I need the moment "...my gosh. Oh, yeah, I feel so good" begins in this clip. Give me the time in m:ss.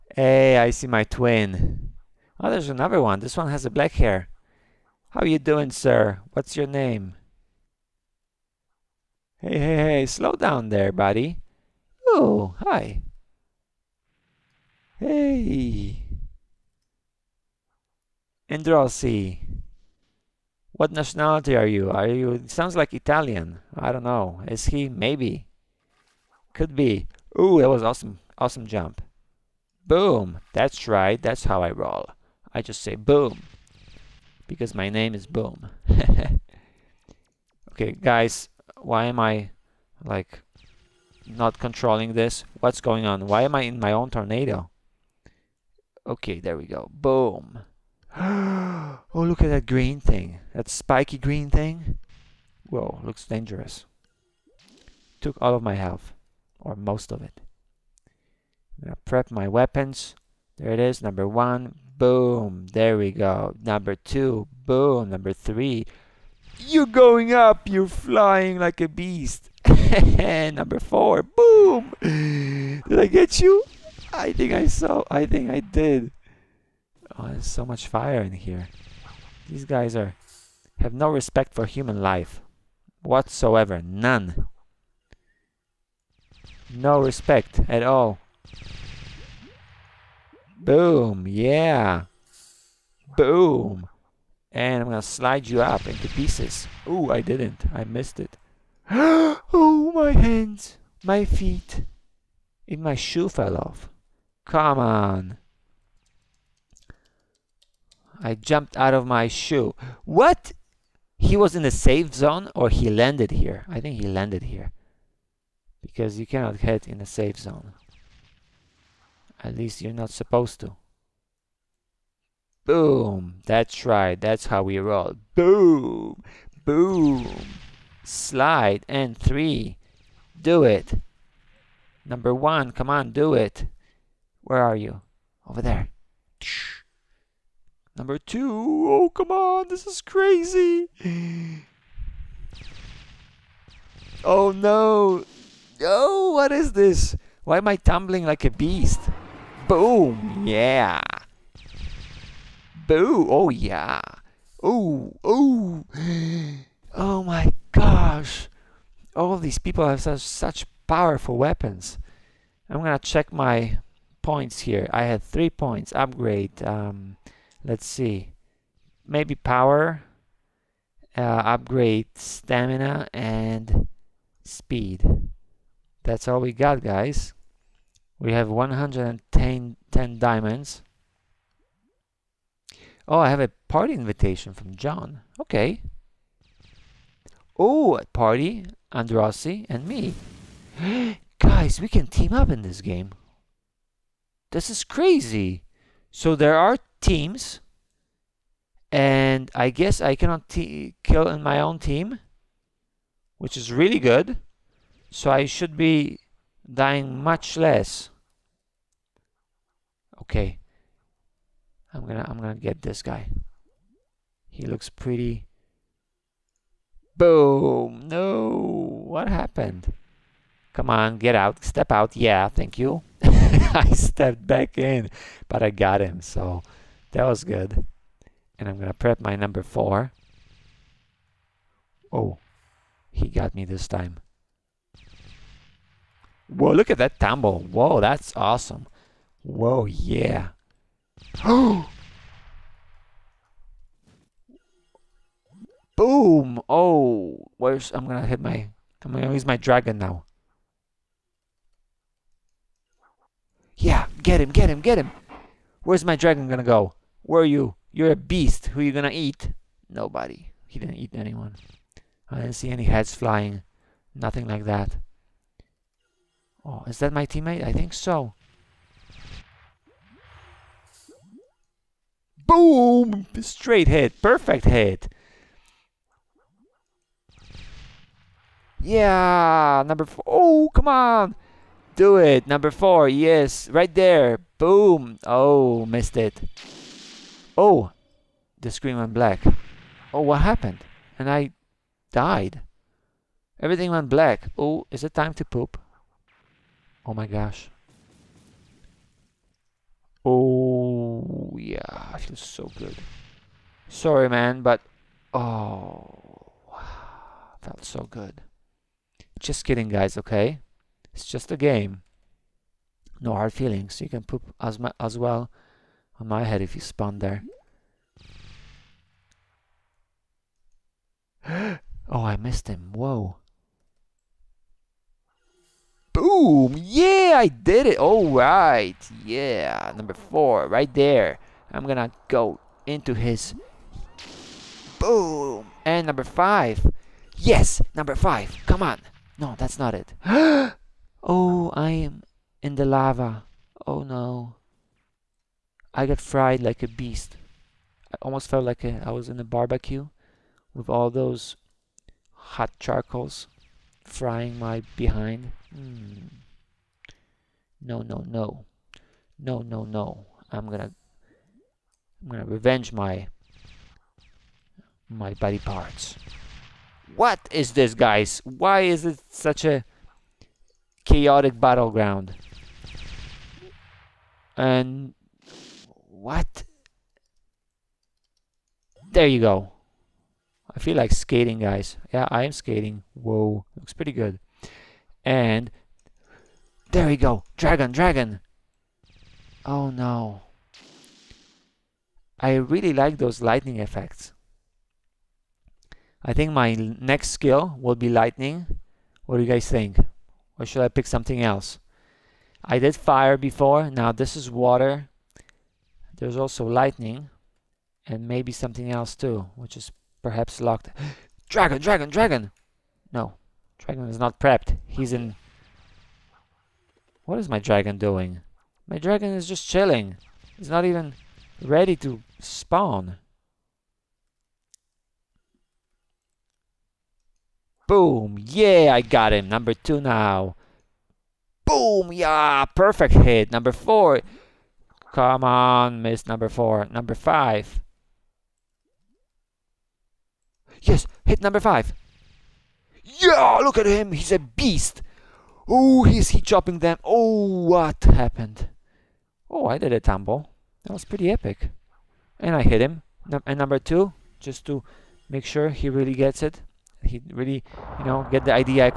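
4:57.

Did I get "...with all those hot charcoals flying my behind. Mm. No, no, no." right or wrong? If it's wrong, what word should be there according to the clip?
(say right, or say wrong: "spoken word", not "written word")
wrong: "frying", not "flying".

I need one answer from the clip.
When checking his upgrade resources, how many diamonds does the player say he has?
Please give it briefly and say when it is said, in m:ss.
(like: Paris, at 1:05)
110, at 2:58.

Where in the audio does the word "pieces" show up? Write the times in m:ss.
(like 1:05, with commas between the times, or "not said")
1:36.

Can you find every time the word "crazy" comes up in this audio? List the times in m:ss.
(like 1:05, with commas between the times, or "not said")
2:20, 3:14.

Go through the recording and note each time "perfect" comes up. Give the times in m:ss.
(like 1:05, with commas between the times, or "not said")
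4:34, 7:12.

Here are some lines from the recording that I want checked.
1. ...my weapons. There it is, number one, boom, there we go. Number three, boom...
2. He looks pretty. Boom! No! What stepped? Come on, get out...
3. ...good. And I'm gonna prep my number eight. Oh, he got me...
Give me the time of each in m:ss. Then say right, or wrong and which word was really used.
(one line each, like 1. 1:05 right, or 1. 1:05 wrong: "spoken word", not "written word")
1. 0:59 wrong: "two", not "three"
2. 3:34 wrong: "happened", not "stepped"
3. 3:47 wrong: "four", not "eight".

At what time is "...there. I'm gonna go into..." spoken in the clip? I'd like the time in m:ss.
5:30.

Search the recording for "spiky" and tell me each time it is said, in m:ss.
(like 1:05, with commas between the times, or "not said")
0:50.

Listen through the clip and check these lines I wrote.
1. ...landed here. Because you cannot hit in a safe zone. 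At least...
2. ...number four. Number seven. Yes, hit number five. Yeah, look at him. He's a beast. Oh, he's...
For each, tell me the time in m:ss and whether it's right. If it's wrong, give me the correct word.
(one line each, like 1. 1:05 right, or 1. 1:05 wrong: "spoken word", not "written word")
1. 1:54 right
2. 7:16 wrong: "five", not "seven".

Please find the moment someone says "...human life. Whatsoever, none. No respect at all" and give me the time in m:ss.
1:21.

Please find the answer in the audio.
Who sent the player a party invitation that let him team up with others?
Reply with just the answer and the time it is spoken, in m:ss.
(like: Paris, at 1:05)
John, at 3:04.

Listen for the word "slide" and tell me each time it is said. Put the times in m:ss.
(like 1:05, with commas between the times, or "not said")
1:35, 2:08.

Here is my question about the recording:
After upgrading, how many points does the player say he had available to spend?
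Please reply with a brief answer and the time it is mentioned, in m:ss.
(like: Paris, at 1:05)
3, at 2:45.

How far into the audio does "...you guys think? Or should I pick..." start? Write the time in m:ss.
6:39.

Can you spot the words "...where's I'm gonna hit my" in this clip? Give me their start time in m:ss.
4:07.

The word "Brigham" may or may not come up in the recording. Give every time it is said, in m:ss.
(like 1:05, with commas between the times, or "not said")
not said.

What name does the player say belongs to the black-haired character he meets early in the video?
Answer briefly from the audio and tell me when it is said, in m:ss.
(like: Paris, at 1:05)
Androsi, at 0:18.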